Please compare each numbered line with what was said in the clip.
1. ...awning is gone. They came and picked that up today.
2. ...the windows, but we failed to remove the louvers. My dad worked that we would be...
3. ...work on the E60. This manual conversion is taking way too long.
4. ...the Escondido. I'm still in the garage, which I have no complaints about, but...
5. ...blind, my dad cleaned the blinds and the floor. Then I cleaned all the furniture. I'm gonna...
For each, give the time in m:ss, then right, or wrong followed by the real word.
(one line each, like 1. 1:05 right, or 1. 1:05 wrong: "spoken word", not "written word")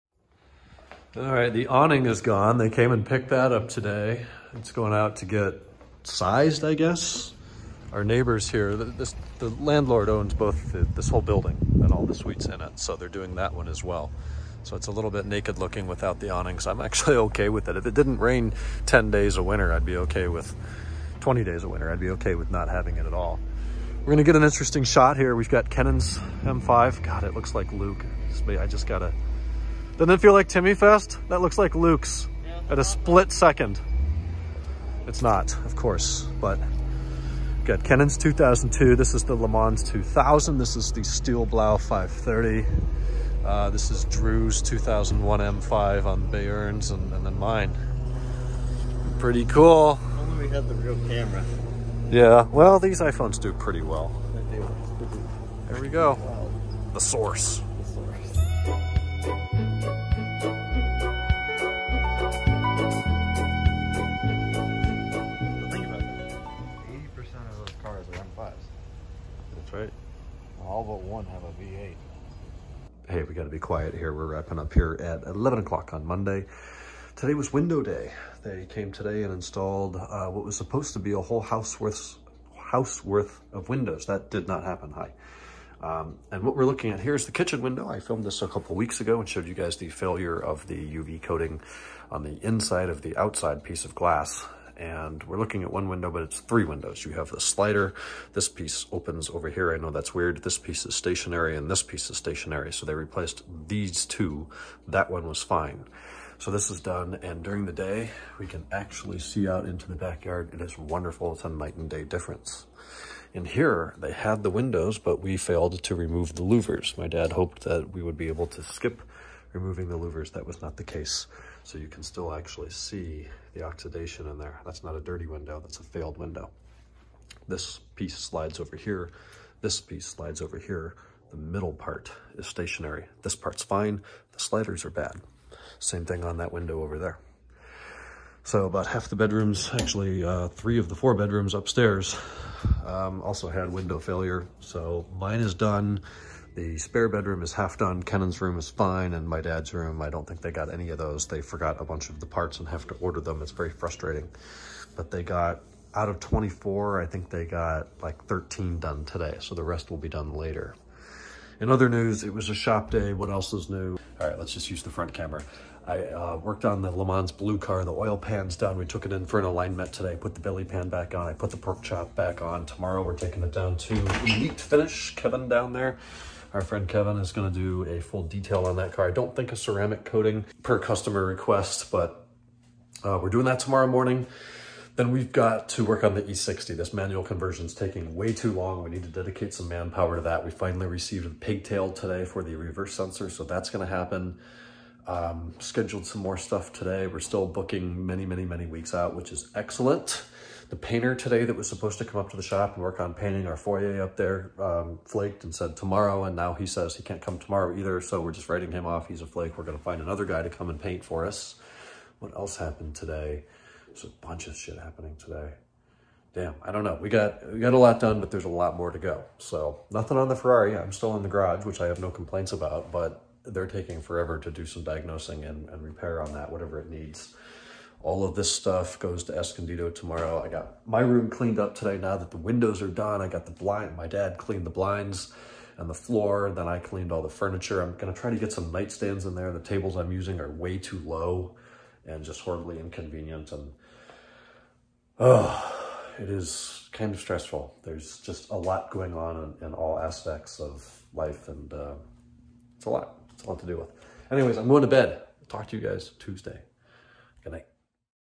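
1. 0:01 right
2. 1:54 wrong: "hoped", not "worked"
3. 3:05 right
4. 3:40 wrong: "Ferrari", not "Escondido"
5. 3:53 right.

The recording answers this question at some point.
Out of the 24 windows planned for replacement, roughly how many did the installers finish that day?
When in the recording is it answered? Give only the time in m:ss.
2:38.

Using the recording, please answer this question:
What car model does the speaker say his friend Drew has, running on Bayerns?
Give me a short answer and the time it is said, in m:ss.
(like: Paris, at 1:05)
2001 M5, at 0:44.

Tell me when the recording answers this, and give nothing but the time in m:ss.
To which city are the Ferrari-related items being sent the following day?
3:49.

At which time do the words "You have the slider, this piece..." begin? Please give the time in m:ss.
1:37.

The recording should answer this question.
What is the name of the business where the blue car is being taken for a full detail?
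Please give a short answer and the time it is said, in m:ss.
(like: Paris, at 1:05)
Elite Finish, at 2:54.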